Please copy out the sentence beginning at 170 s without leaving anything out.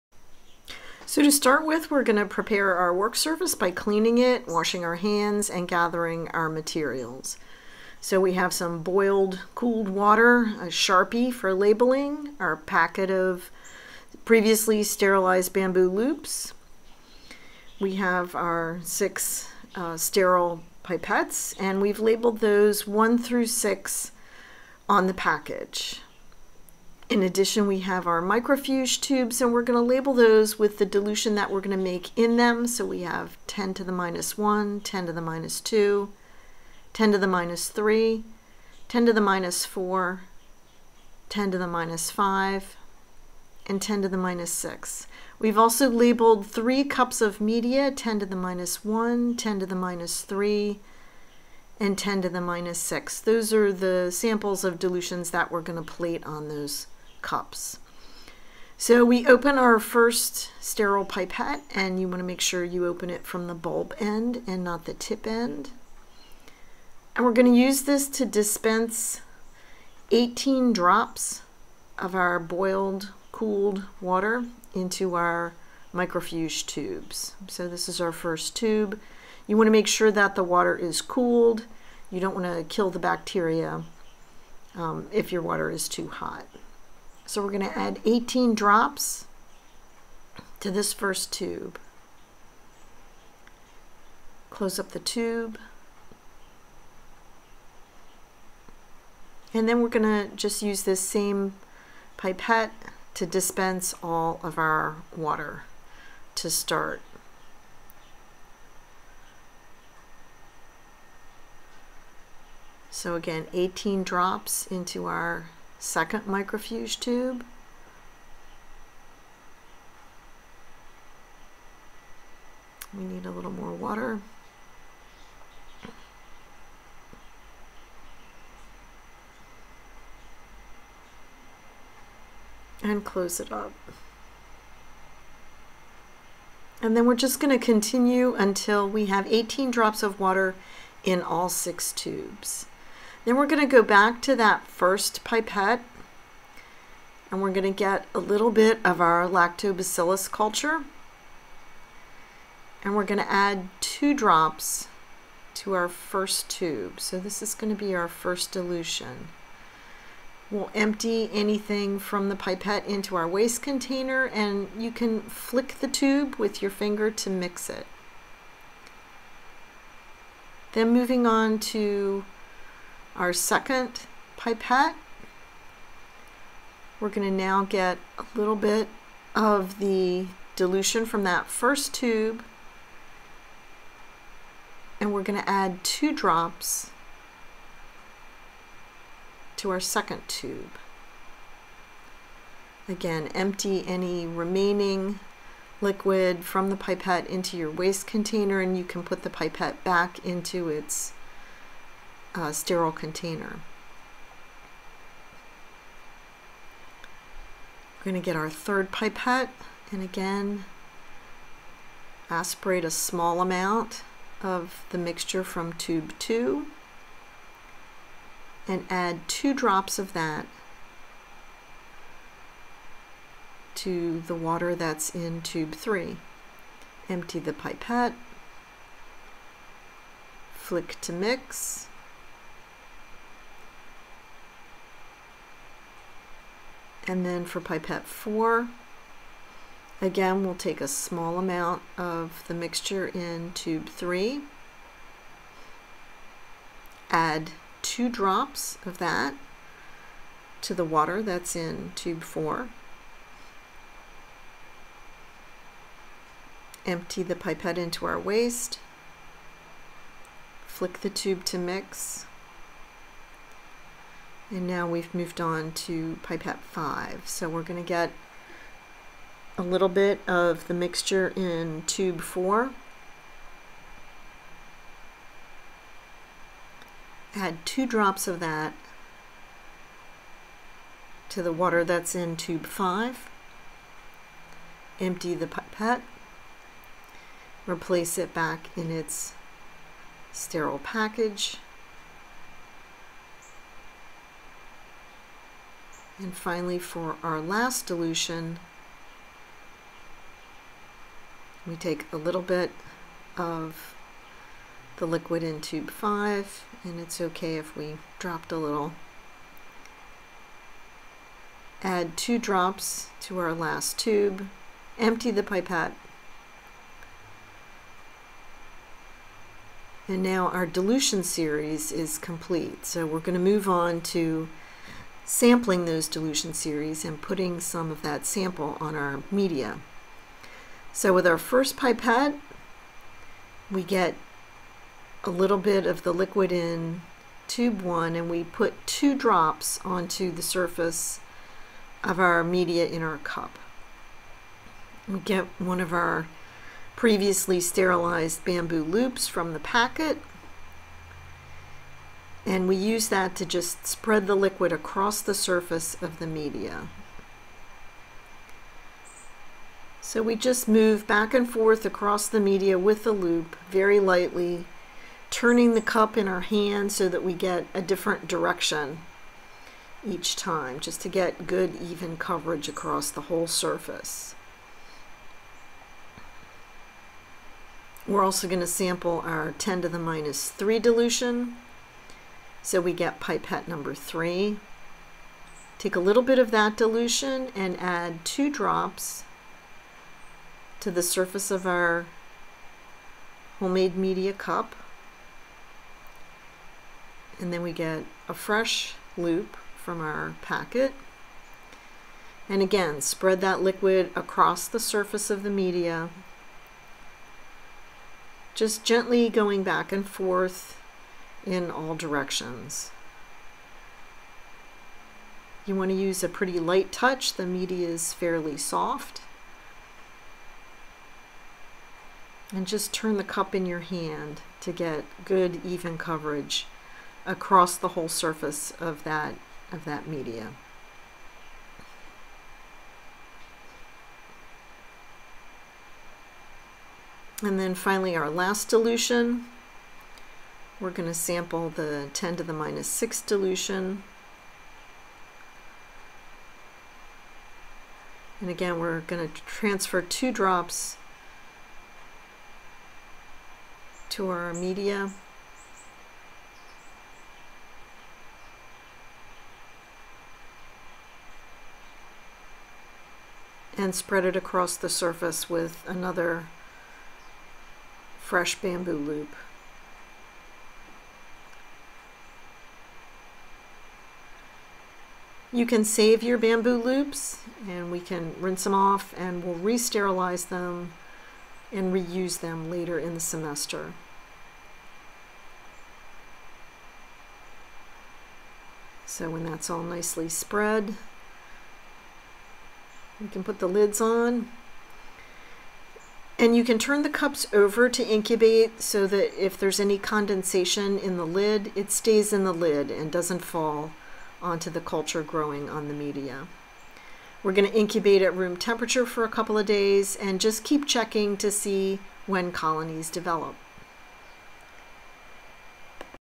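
Then moving on to our second pipette.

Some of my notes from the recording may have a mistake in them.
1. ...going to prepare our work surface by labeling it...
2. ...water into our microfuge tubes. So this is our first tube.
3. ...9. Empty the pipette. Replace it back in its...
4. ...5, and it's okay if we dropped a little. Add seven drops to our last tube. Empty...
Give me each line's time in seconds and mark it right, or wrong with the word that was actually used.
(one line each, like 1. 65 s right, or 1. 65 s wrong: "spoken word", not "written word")
1. 2 s wrong: "cleaning", not "labeling"
2. 74 s right
3. 282 s wrong: "5", not "9"
4. 305 s wrong: "two", not "seven".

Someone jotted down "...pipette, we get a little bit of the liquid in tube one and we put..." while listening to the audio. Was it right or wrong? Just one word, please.
right.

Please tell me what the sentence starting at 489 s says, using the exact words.
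So when that's all nicely spread, we can put the lids on.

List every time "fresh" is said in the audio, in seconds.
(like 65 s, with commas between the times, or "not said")
398 s, 468 s.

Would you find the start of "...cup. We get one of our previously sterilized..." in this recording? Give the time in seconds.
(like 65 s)
343 s.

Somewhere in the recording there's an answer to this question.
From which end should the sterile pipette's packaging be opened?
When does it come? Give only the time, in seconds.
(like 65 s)
63 s.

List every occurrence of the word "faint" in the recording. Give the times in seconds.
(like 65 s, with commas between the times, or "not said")
not said.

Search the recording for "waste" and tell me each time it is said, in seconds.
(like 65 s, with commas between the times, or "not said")
163 s, 197 s, 258 s.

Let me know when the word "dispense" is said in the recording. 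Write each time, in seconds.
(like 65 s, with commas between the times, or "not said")
68 s, 103 s.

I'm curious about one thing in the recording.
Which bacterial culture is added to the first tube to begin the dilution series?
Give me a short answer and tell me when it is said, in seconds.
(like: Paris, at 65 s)
lactobacillus, at 149 s.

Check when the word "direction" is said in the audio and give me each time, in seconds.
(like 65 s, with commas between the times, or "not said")
368 s, 411 s.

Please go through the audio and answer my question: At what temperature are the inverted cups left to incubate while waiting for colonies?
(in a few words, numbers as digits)
room temperature.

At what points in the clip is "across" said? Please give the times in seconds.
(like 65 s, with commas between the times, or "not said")
354 s, 361 s, 372 s, 404 s, 427 s, 464 s.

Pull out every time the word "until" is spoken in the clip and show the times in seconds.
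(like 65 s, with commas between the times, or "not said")
138 s.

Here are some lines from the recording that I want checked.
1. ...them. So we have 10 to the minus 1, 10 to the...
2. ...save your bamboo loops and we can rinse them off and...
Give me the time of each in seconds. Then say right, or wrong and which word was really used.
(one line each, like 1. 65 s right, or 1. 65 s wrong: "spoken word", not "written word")
1. 32 s right
2. 475 s right.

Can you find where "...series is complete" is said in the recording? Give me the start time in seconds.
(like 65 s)
321 s.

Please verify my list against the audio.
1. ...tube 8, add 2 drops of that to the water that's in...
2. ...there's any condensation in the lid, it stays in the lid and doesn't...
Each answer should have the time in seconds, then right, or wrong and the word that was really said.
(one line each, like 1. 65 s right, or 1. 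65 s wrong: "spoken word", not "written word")
1. 243 s wrong: "3", not "8"
2. 499 s right.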